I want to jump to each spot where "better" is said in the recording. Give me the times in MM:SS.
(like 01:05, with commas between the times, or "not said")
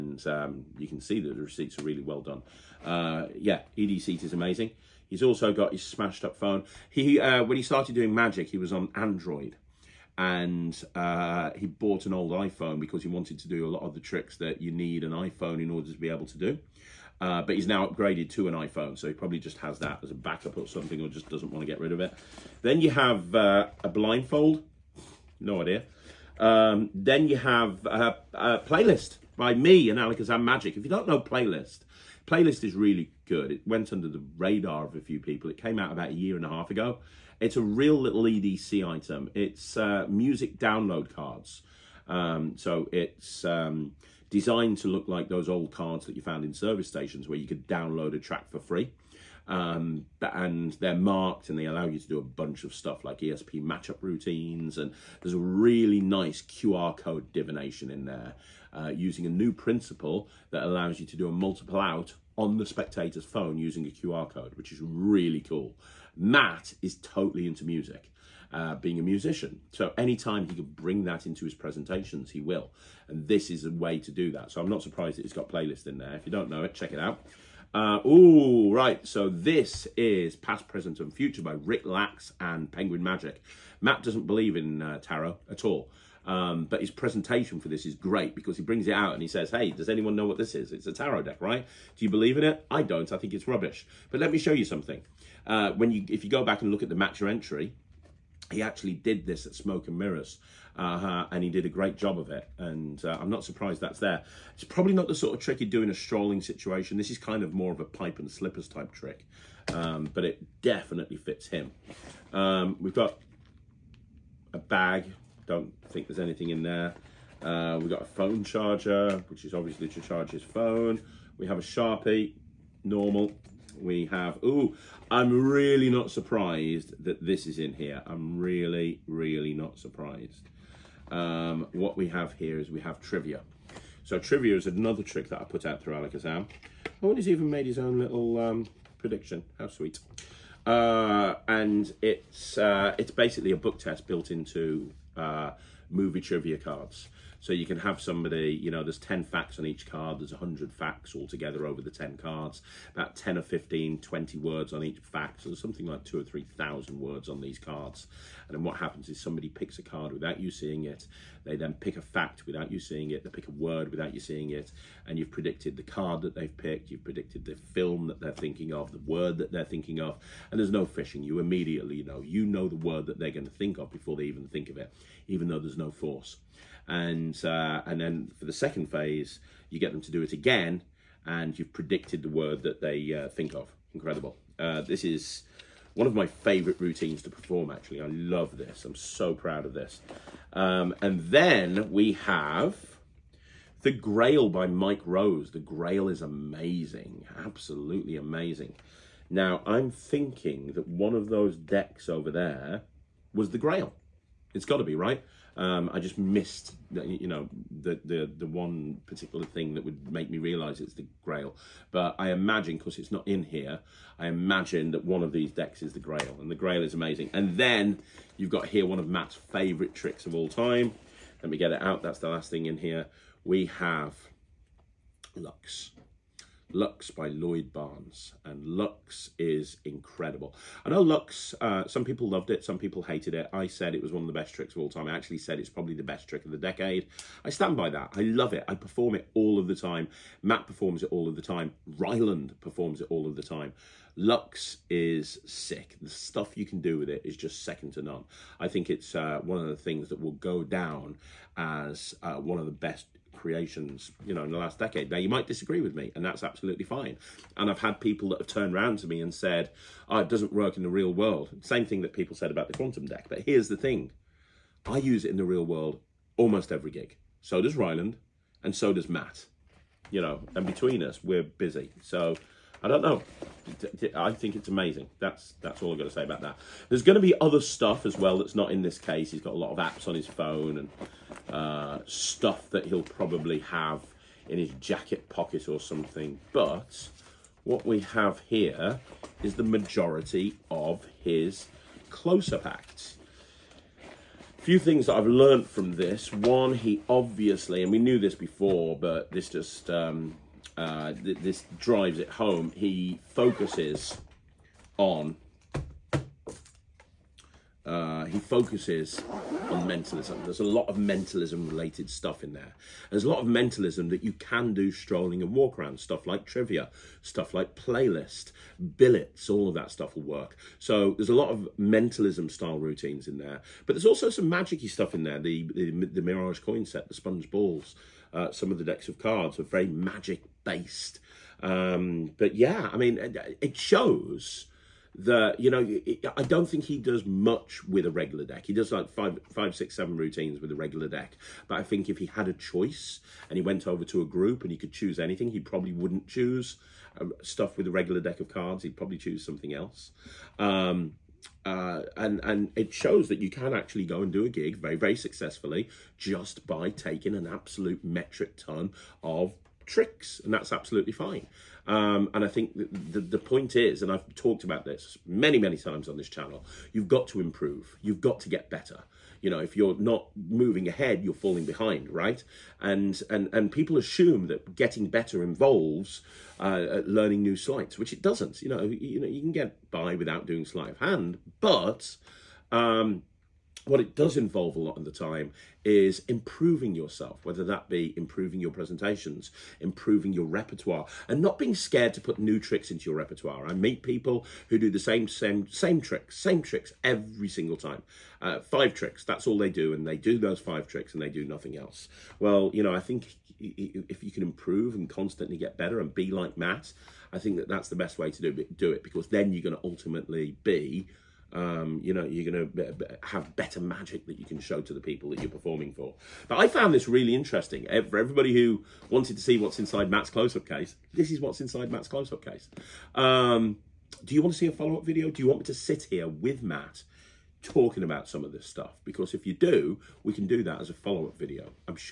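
06:08, 06:15, 06:45, 06:53.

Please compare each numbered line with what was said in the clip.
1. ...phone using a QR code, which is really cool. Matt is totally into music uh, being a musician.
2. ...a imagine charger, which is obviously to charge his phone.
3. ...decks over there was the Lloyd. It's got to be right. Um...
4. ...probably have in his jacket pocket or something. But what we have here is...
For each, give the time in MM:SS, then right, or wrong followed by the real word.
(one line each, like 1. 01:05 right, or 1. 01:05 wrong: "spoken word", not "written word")
1. 01:03 right
2. 01:58 wrong: "phone", not "imagine"
3. 03:21 wrong: "Grail", not "Lloyd"
4. 04:43 right.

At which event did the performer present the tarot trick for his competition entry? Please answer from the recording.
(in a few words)
Smoke and Mirrors.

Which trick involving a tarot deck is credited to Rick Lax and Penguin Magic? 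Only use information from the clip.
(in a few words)
Past, Present and Future.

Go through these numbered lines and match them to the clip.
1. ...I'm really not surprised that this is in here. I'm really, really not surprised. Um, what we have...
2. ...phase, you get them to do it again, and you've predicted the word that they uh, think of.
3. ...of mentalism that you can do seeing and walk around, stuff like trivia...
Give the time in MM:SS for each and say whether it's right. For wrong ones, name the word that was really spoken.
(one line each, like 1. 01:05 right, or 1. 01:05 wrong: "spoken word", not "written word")
1. 02:05 right
2. 02:58 right
3. 05:13 wrong: "strolling", not "seeing".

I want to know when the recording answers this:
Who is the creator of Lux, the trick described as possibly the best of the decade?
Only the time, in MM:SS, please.
03:47.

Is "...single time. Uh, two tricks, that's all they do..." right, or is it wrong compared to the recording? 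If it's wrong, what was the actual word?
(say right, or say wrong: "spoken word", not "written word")
wrong: "five", not "two".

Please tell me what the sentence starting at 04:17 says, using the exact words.
And I've had people that have turned around to me and said, oh, it doesn't work in the real world.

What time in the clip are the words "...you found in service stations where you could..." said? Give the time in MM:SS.
00:46.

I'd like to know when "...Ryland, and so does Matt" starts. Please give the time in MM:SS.
04:27.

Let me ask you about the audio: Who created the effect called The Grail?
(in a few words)
Mike Rose.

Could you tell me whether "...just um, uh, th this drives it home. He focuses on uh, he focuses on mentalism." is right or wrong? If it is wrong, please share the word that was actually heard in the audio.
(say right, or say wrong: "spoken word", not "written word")
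right.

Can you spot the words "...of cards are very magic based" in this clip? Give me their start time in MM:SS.
05:29.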